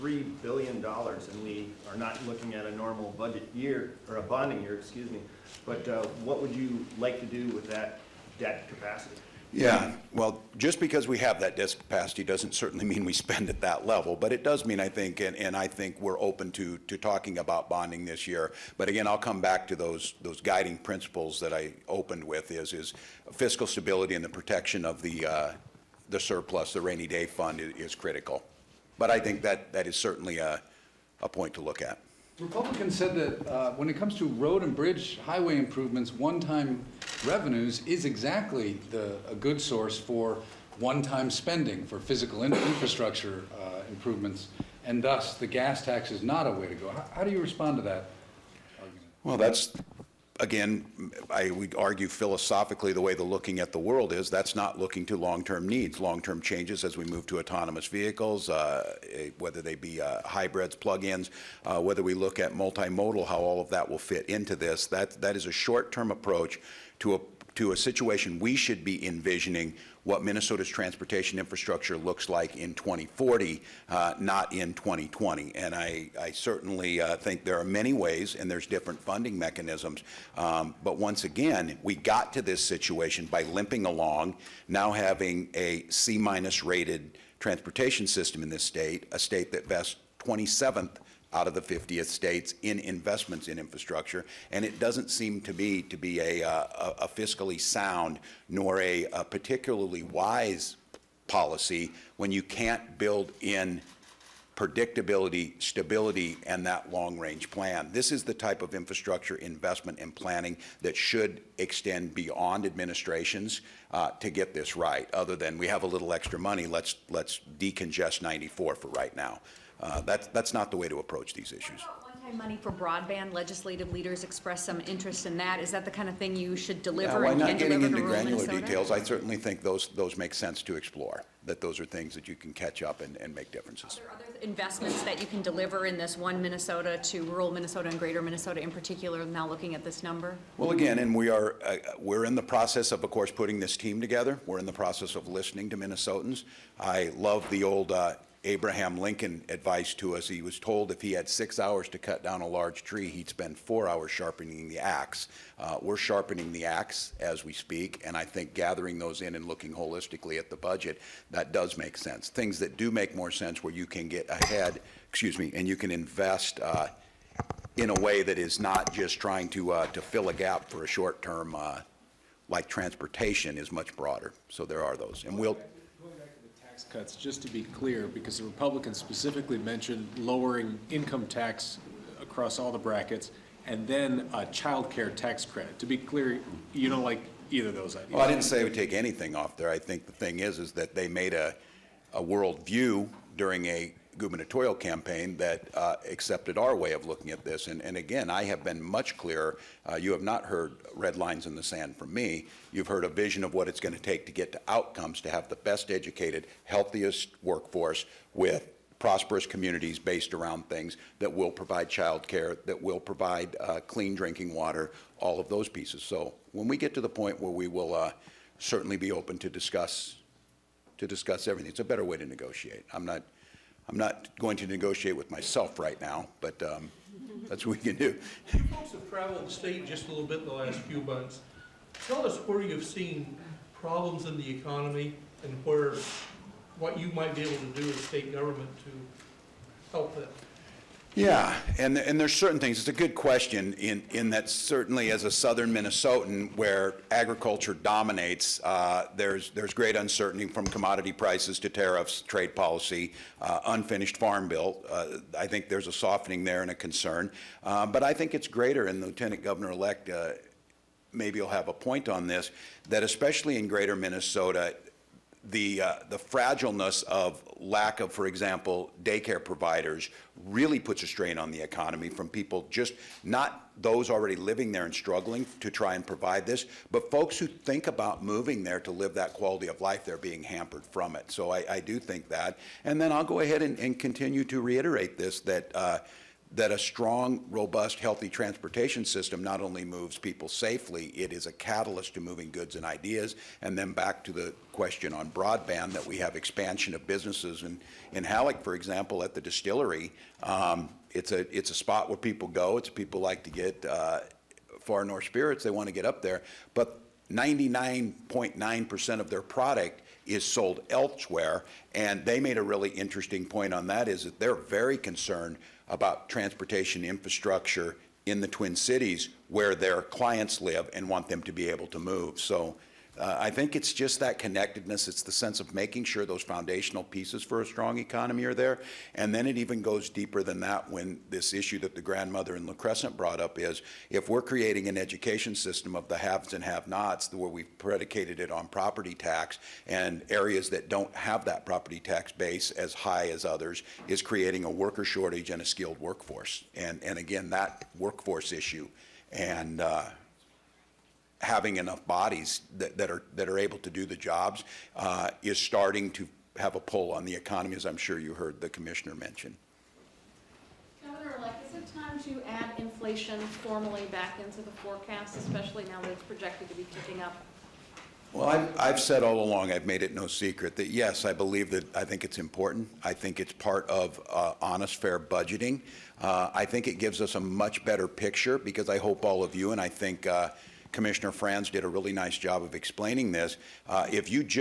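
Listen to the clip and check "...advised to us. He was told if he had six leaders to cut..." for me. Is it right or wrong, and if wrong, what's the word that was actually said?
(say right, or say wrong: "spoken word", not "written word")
wrong: "hours", not "leaders".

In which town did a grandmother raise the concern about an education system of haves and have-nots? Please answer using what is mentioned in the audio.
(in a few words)
La Crescent.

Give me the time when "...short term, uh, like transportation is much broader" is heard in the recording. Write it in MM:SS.
02:50.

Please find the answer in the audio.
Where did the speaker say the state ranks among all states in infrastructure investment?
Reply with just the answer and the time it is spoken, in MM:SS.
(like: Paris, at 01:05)
27th, at 01:30.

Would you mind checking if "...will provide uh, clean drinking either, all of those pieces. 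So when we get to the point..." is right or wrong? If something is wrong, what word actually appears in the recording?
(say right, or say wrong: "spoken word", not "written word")
wrong: "water", not "either".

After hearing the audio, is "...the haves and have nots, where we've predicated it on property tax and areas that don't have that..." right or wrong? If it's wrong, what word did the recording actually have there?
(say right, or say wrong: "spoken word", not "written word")
right.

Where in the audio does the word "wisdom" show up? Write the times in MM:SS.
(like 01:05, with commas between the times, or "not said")
not said.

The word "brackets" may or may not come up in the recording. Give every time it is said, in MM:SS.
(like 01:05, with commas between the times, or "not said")
03:02.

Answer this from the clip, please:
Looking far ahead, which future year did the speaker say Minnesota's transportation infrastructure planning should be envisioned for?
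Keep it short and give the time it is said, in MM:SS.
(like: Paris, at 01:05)
2040, at 01:12.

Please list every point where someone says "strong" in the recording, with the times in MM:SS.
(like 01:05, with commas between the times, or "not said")
04:46, 05:27.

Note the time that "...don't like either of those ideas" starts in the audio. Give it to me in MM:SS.
03:06.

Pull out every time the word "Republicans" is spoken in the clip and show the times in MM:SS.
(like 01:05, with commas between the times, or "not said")
00:32, 02:58.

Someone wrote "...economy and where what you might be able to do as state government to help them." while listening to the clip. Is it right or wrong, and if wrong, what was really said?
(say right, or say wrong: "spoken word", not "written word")
right.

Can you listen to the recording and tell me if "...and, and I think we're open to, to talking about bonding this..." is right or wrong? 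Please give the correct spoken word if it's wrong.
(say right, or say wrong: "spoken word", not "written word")
right.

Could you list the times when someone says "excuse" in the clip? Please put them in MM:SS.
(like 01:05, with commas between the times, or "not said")
00:04, 02:45.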